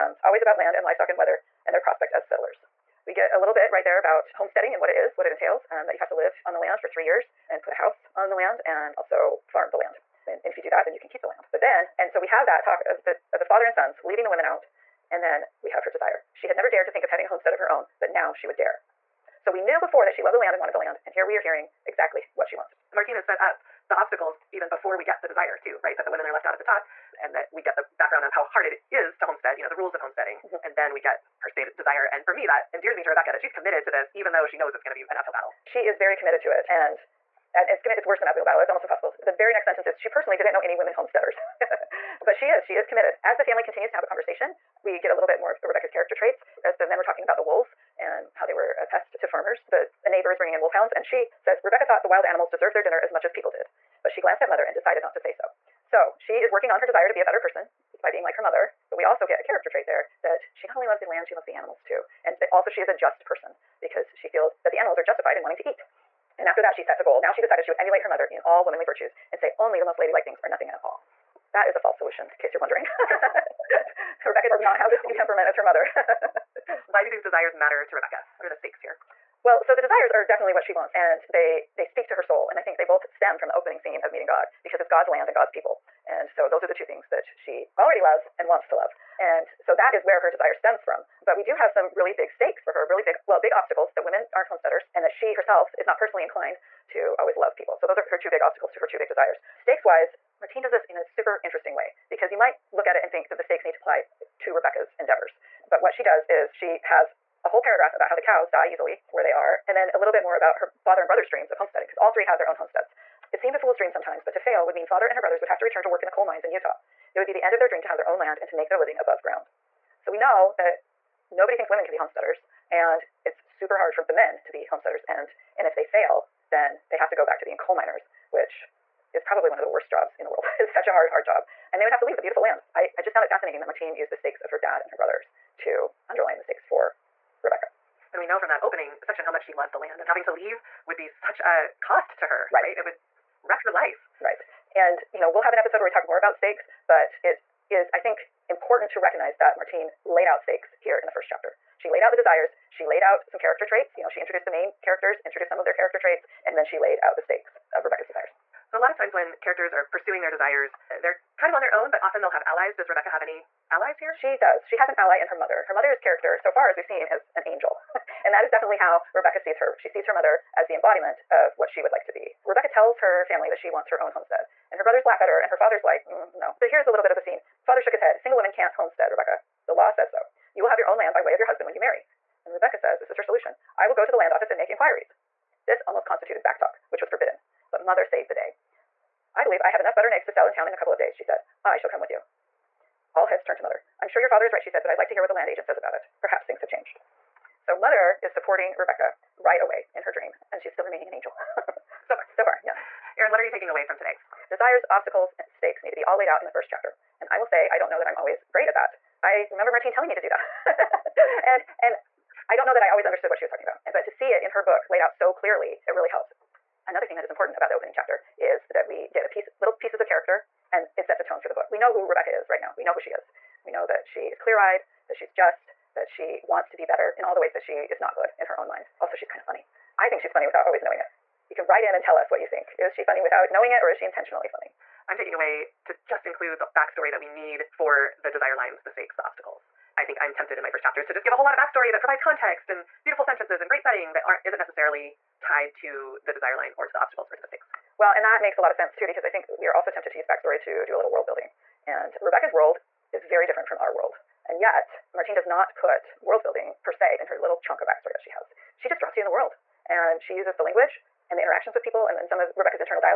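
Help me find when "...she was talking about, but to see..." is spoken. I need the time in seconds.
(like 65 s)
213 s.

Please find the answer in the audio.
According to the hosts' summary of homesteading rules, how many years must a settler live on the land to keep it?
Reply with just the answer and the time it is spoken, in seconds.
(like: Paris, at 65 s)
3, at 6 s.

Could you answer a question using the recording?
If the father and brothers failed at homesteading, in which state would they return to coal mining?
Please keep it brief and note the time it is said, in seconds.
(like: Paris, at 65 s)
Utah, at 116 s.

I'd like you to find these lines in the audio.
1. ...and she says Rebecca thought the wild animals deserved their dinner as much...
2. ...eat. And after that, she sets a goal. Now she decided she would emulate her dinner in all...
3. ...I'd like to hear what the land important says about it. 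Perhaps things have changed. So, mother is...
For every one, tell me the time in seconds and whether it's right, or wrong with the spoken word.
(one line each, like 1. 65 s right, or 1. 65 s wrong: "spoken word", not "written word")
1. 50 s right
2. 65 s wrong: "mother", not "dinner"
3. 194 s wrong: "agent", not "important".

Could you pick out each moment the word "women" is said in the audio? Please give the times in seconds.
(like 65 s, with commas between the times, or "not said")
14 s, 26 s, 40 s, 94 s, 121 s, 178 s.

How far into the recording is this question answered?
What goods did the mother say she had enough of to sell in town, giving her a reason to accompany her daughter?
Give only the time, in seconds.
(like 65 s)
189 s.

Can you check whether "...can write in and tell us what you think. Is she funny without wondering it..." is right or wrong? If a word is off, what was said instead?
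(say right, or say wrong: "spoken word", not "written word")
wrong: "knowing", not "wondering".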